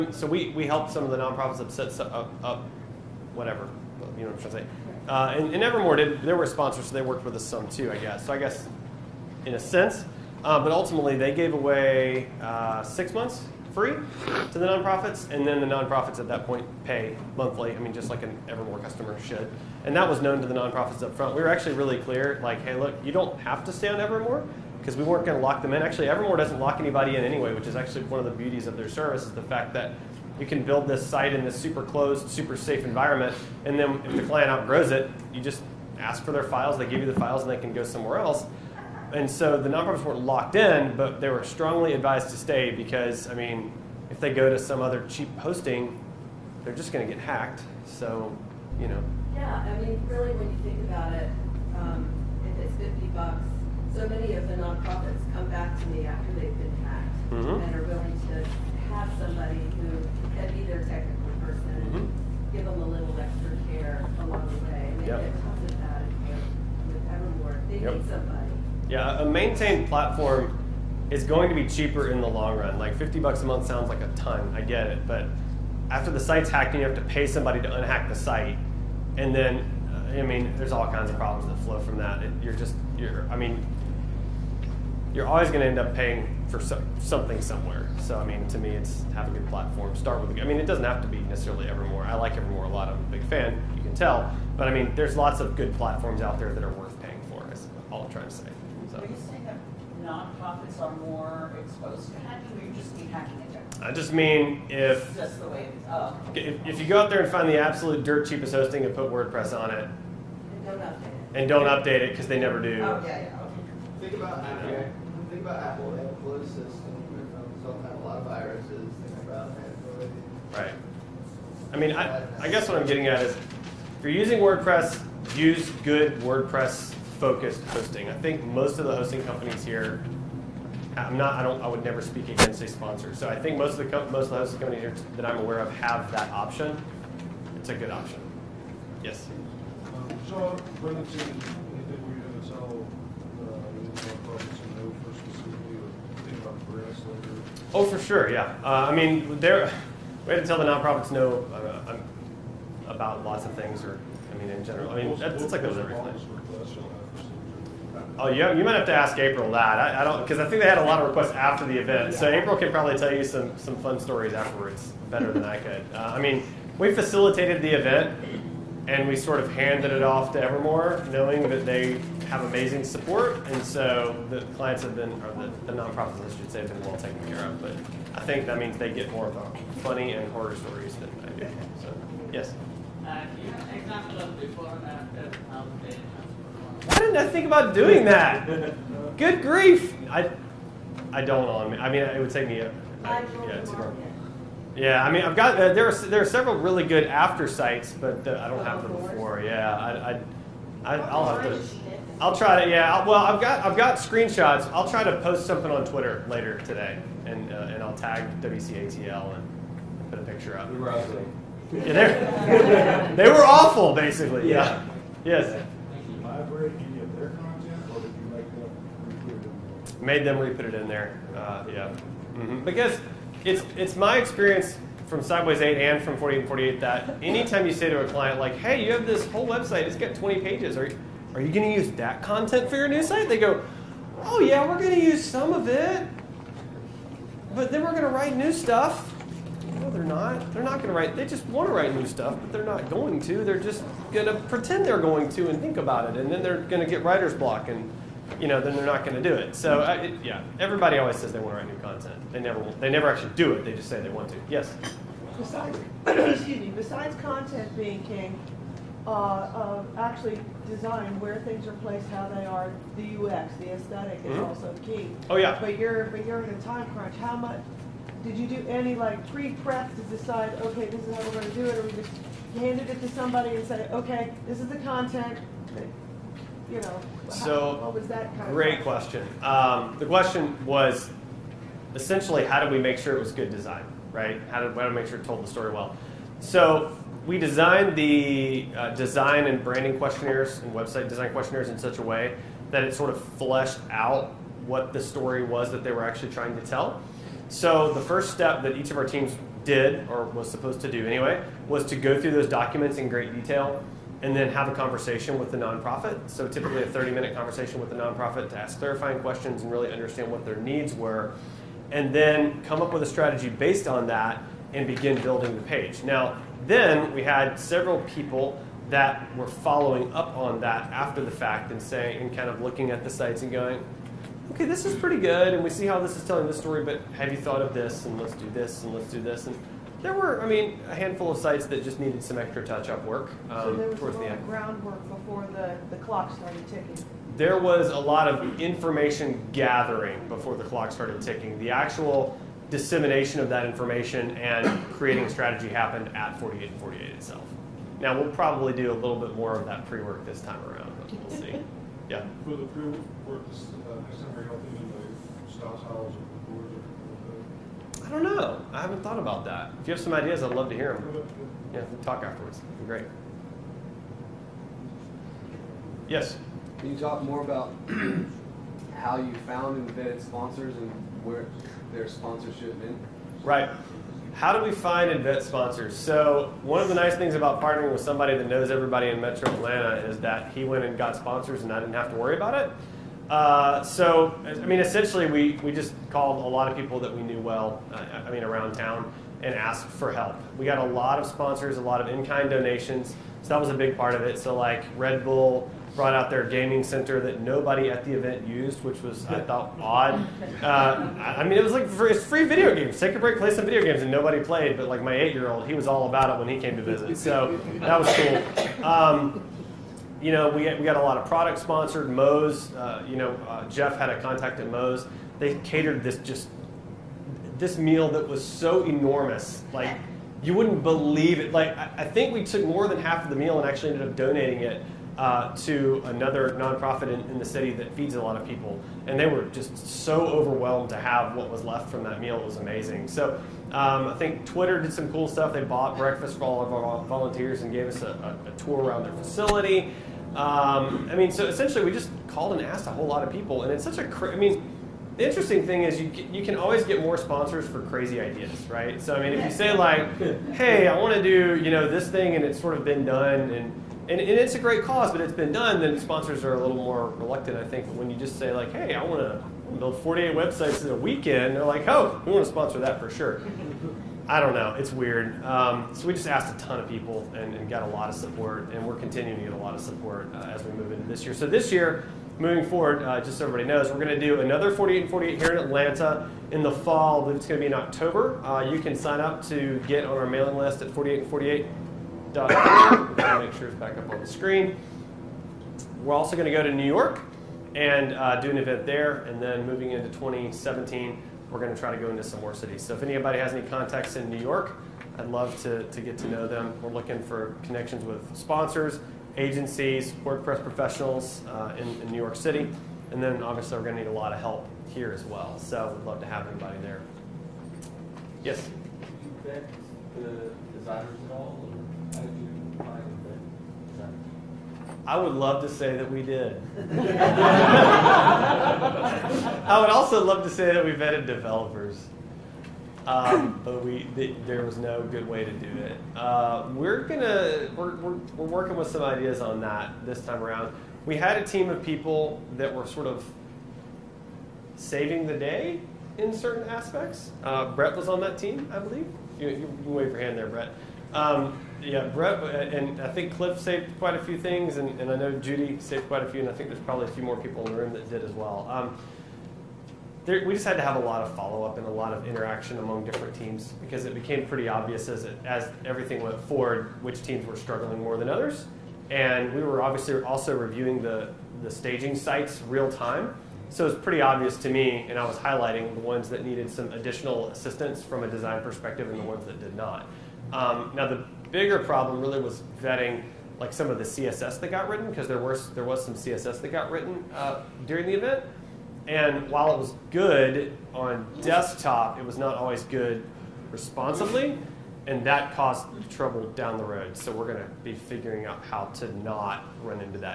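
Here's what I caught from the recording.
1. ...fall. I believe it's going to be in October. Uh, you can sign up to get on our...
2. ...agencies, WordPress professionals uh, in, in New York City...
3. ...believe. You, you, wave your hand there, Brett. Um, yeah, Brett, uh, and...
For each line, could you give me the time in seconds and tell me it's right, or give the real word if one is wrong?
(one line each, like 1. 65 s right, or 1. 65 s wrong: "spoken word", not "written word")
1. 476 s right
2. 499 s right
3. 538 s right.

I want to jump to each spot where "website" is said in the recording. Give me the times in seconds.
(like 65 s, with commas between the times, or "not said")
229 s, 290 s, 460 s.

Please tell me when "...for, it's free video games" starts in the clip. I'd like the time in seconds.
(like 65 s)
401 s.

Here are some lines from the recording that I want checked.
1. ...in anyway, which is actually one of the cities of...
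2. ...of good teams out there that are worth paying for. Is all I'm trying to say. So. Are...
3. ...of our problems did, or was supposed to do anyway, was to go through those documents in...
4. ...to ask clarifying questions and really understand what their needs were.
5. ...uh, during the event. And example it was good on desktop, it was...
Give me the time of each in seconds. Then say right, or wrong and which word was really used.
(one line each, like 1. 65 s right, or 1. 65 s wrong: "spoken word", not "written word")
1. 27 s wrong: "beauties", not "cities"
2. 95 s wrong: "platforms", not "teams"
3. 298 s wrong: "teams", not "problems"
4. 308 s right
5. 577 s wrong: "while", not "example".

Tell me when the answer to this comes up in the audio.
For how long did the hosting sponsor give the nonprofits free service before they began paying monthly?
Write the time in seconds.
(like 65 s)
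12 s.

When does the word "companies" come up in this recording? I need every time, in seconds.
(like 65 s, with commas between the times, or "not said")
129 s, 134 s.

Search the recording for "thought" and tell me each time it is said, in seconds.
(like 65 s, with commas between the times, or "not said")
327 s, 359 s, 399 s.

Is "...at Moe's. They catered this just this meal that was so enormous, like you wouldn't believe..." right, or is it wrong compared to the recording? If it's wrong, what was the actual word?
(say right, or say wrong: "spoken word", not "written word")
right.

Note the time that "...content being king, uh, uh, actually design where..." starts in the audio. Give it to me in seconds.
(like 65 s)
257 s.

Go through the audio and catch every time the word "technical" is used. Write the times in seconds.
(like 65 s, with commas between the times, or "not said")
60 s.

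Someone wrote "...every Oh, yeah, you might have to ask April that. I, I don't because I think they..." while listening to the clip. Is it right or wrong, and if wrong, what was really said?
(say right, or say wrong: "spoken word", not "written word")
right.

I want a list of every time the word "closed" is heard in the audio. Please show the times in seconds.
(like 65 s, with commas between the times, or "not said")
31 s, 116 s.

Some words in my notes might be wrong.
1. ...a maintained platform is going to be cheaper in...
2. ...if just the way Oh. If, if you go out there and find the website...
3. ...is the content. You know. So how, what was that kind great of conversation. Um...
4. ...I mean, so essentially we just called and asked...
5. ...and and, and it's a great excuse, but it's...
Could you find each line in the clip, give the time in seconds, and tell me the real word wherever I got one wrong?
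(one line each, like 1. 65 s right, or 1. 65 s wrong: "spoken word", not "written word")
1. 69 s right
2. 104 s wrong: "absolute", not "website"
3. 274 s wrong: "question", not "conversation"
4. 441 s right
5. 453 s wrong: "cause", not "excuse".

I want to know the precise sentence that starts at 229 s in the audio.
It's got 20 pages," or are you going to use that content for your new site?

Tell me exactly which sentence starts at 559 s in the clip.
And we were obviously also reviewing the, the staging sites real time.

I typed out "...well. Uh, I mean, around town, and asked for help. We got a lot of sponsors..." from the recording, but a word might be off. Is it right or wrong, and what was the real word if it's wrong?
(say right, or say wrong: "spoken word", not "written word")
right.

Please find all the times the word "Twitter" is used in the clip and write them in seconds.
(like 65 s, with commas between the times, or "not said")
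205 s, 434 s.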